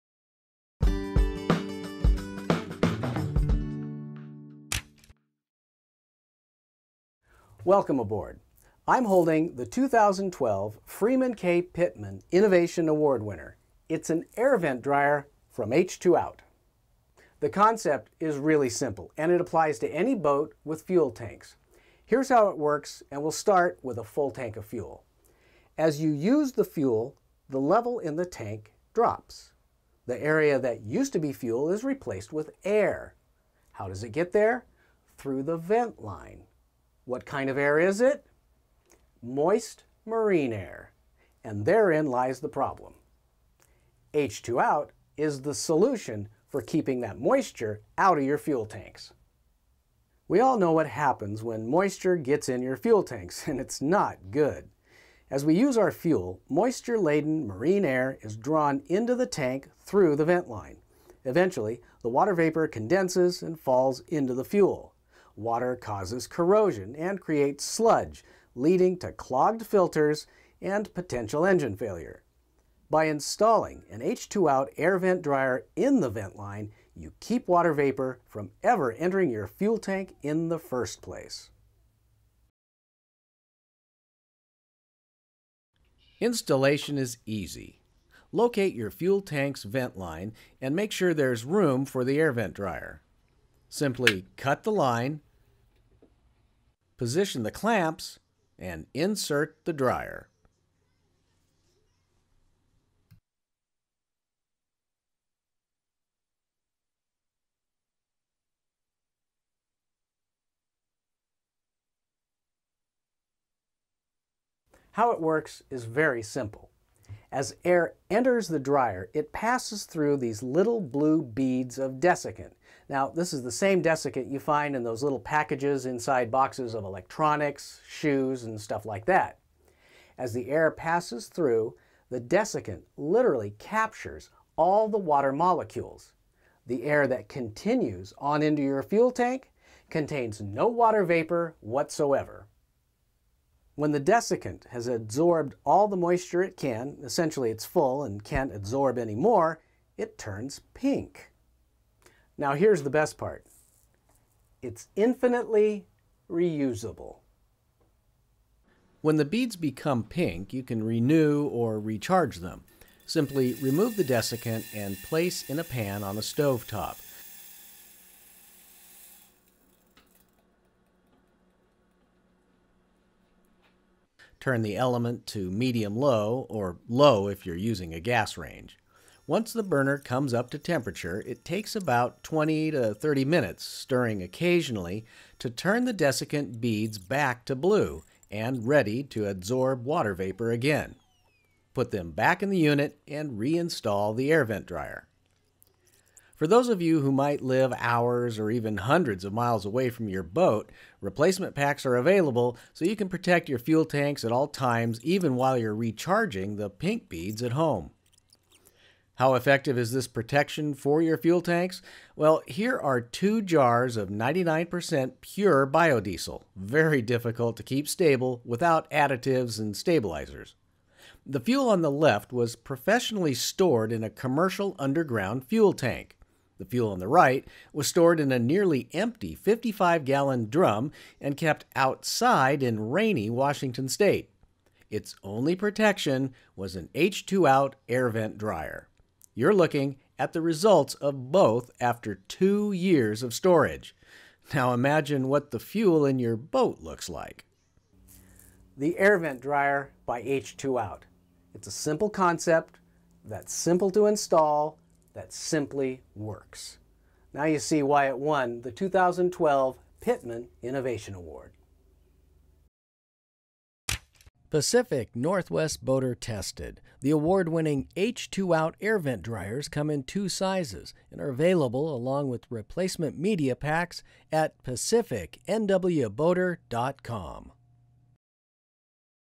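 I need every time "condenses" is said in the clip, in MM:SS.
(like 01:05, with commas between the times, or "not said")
01:02.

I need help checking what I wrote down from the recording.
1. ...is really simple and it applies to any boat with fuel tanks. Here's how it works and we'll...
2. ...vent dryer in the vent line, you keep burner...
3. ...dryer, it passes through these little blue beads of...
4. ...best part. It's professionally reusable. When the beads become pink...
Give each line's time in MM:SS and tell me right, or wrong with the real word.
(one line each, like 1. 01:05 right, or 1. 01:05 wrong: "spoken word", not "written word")
1. 00:18 right
2. 01:14 wrong: "water", not "burner"
3. 01:58 right
4. 02:32 wrong: "infinitely", not "professionally".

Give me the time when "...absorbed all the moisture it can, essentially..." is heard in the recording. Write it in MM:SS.
02:24.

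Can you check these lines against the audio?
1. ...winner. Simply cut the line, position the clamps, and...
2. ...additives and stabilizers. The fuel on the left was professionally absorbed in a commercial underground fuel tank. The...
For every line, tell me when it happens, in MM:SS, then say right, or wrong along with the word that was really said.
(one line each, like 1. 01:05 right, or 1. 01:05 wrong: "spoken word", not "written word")
1. 01:32 wrong: "dryer", not "winner"
2. 03:38 wrong: "stored", not "absorbed".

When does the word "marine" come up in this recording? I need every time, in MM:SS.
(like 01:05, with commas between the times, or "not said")
00:40, 00:57.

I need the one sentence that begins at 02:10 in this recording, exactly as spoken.
As the air passes through, the desiccant literally captures all the water molecules.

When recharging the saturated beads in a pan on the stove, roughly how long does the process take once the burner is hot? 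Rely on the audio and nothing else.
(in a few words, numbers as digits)
20 to 30 minutes.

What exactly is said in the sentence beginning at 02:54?
Turn the element to medium low or low if you're using a gas range.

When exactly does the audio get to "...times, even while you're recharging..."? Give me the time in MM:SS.
03:24.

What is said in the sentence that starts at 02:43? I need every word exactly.
Simply remove the desiccant and place in a pan on a stove top.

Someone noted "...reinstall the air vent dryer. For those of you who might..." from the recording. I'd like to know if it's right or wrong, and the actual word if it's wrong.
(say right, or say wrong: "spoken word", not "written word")
right.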